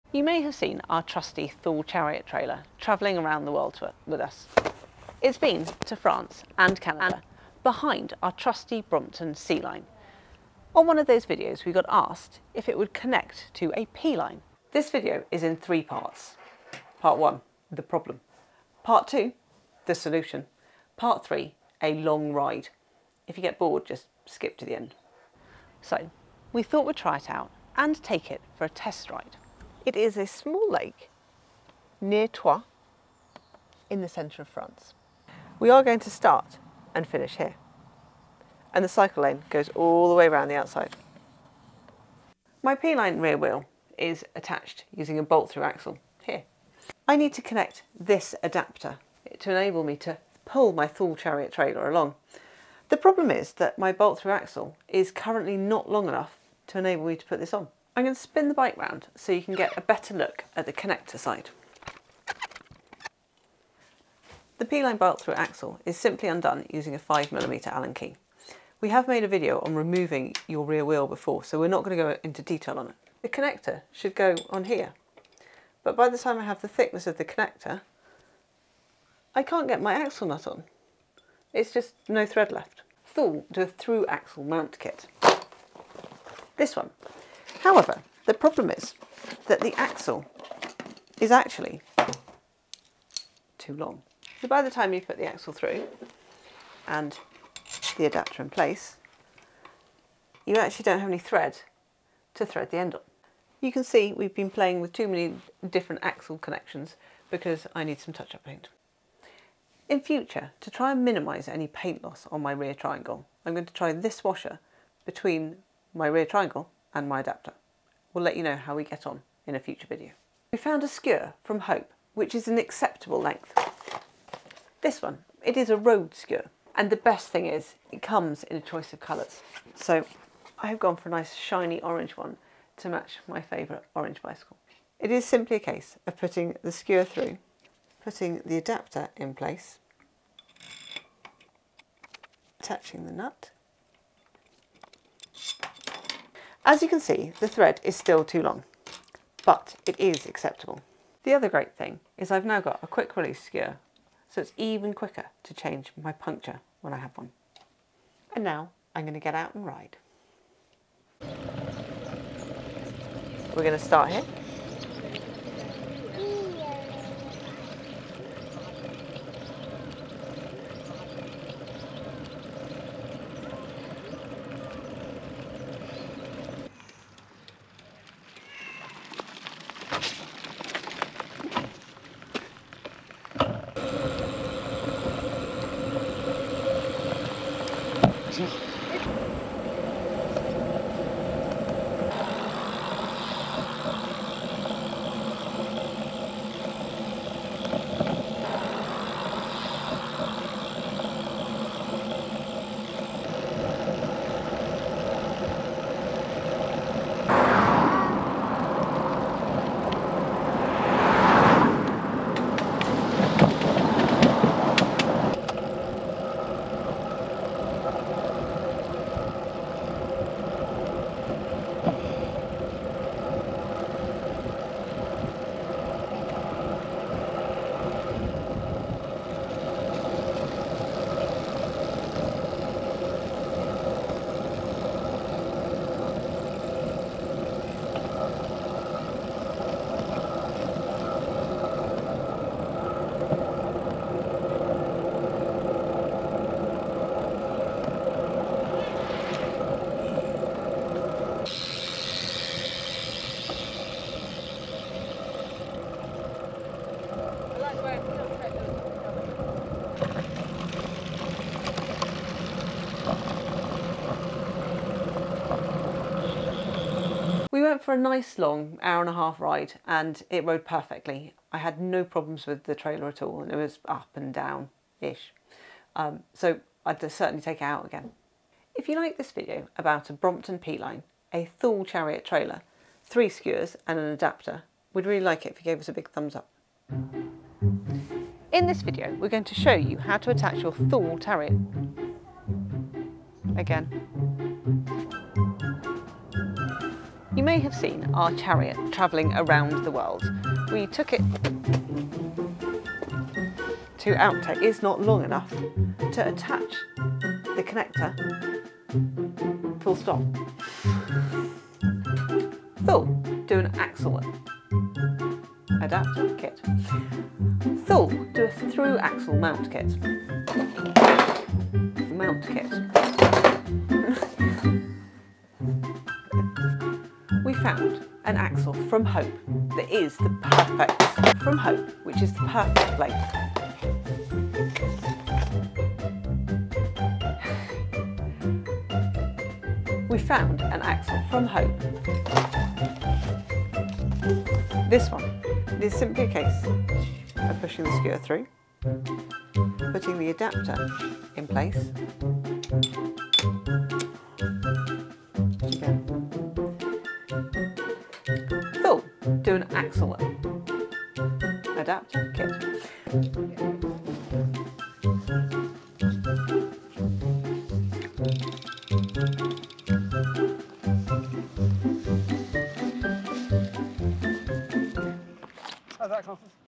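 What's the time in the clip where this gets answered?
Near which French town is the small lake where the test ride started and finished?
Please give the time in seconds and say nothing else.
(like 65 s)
32 s.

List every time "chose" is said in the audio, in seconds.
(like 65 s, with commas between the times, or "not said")
not said.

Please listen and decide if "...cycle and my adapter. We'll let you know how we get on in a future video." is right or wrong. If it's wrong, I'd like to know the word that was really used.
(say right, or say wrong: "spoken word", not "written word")
wrong: "triangle", not "cycle".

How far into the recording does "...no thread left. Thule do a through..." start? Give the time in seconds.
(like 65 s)
82 s.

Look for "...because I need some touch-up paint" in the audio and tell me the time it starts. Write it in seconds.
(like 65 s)
107 s.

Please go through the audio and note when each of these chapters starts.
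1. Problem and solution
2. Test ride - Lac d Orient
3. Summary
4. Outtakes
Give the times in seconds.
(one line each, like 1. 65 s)
1. 42 s
2. 161 s
3. 267 s
4. 286 s.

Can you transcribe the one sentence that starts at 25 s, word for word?
So, we thought we'd try it out and take it for a test ride.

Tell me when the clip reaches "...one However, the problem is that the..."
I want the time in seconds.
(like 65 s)
86 s.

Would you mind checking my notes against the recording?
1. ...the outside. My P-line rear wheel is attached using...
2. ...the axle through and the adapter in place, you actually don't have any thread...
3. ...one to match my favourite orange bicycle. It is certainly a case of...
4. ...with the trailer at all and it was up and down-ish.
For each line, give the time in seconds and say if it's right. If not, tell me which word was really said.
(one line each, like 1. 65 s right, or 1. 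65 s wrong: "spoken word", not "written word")
1. 40 s right
2. 95 s right
3. 132 s wrong: "simply", not "certainly"
4. 272 s right.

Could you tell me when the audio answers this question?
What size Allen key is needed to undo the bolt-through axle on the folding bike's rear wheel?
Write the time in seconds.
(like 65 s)
66 s.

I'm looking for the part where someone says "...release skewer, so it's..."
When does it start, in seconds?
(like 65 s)
153 s.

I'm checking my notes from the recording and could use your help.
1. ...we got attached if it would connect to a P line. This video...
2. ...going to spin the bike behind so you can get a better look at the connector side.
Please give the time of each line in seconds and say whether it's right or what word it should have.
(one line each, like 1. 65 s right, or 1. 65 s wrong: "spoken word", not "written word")
1. 11 s wrong: "asked", not "attached"
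2. 58 s wrong: "round", not "behind".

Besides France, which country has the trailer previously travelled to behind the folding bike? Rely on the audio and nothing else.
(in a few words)
Canada.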